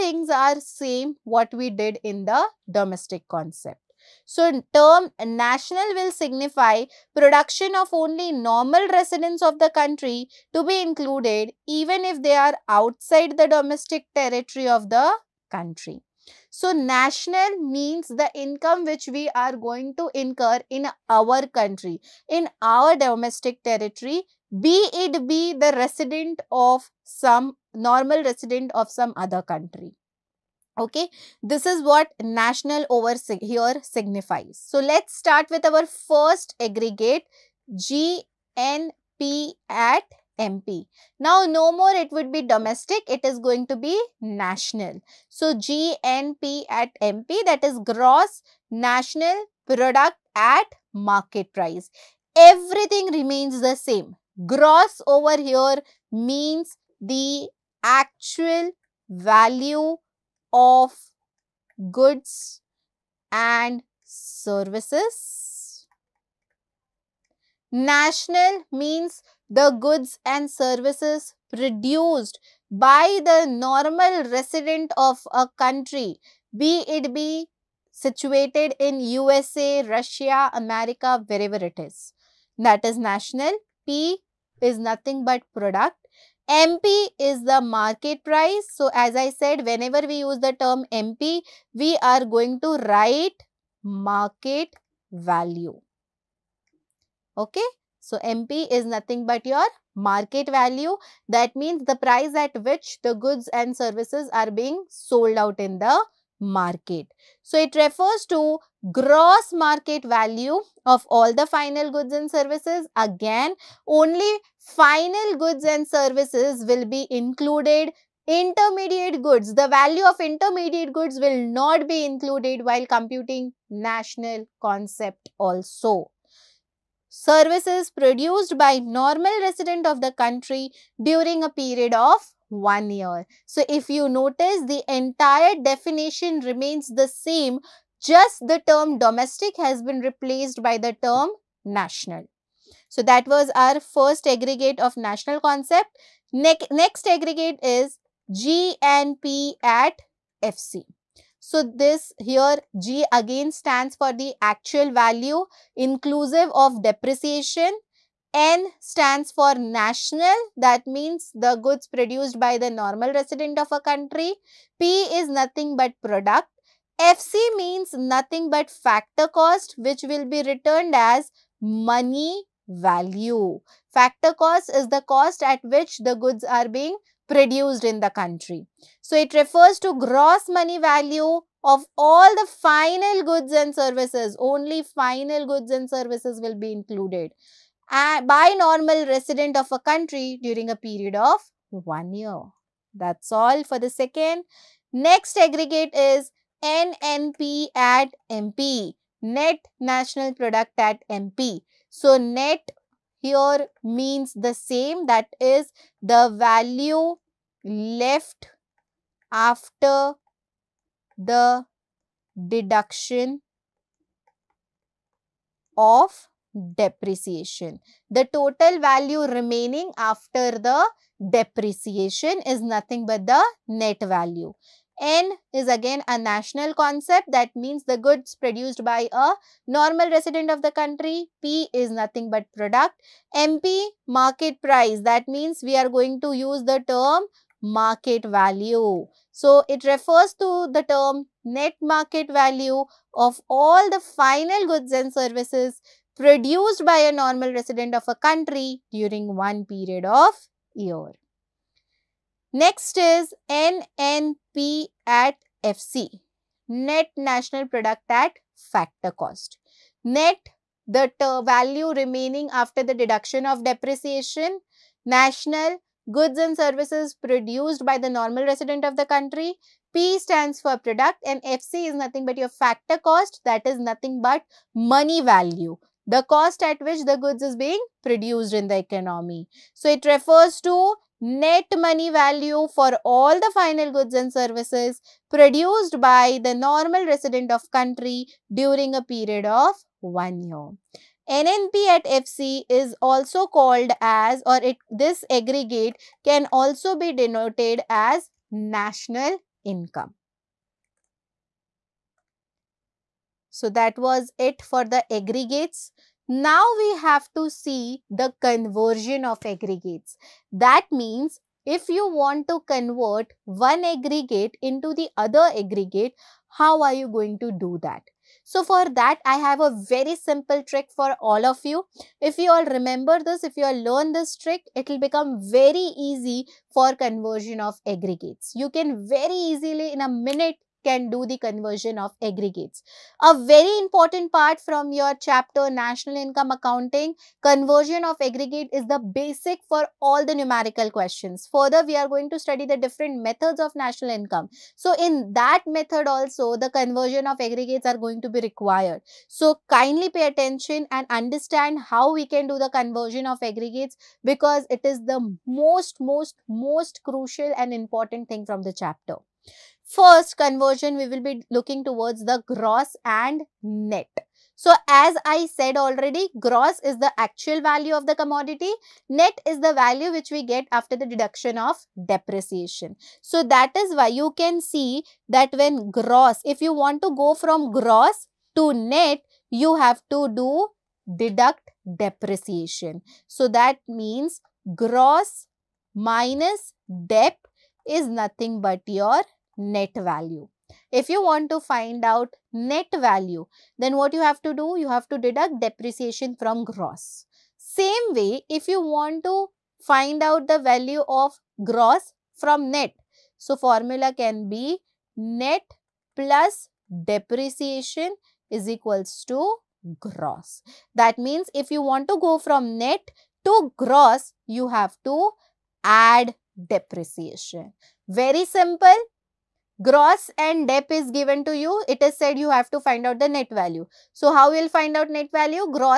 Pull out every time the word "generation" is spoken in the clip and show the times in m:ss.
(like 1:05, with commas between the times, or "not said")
not said.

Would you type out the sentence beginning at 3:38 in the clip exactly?
The total value remaining after the depreciation is nothing but the net value.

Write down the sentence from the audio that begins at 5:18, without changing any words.
So for that, I have a very simple trick for all of you.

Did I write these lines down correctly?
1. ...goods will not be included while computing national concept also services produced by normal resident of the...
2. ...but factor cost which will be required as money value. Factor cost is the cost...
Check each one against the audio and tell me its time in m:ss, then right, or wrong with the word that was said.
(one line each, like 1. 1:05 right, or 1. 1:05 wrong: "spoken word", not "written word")
1. 2:00 right
2. 2:48 wrong: "returned", not "required".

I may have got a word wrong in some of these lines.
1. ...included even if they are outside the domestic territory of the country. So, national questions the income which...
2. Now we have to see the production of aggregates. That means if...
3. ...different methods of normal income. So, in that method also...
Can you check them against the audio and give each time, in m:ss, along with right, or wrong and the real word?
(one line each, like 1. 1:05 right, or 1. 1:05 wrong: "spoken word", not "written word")
1. 0:10 wrong: "means", not "questions"
2. 5:06 wrong: "conversion", not "production"
3. 5:42 wrong: "national", not "normal".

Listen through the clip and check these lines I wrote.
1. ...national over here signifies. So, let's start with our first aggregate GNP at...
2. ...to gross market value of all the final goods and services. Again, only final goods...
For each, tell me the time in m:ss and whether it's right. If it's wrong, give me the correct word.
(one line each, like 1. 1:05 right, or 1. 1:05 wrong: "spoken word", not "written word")
1. 0:32 right
2. 1:48 right.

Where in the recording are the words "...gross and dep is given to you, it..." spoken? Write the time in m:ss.
6:59.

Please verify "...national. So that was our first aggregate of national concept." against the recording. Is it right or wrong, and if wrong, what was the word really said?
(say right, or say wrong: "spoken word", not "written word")
right.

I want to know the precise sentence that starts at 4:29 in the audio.
P stands for product and FC is nothing but your factor cost that is nothing but money value.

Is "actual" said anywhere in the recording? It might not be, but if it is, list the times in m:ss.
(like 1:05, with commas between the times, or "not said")
0:57, 2:34, 6:07.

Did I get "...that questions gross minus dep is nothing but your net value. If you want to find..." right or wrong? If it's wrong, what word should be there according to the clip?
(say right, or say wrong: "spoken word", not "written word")
wrong: "means", not "questions".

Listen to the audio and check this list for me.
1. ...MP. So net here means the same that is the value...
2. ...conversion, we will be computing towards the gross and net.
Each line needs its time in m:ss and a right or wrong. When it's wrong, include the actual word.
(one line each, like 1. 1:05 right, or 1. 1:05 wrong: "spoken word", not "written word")
1. 3:21 right
2. 6:00 wrong: "looking", not "computing".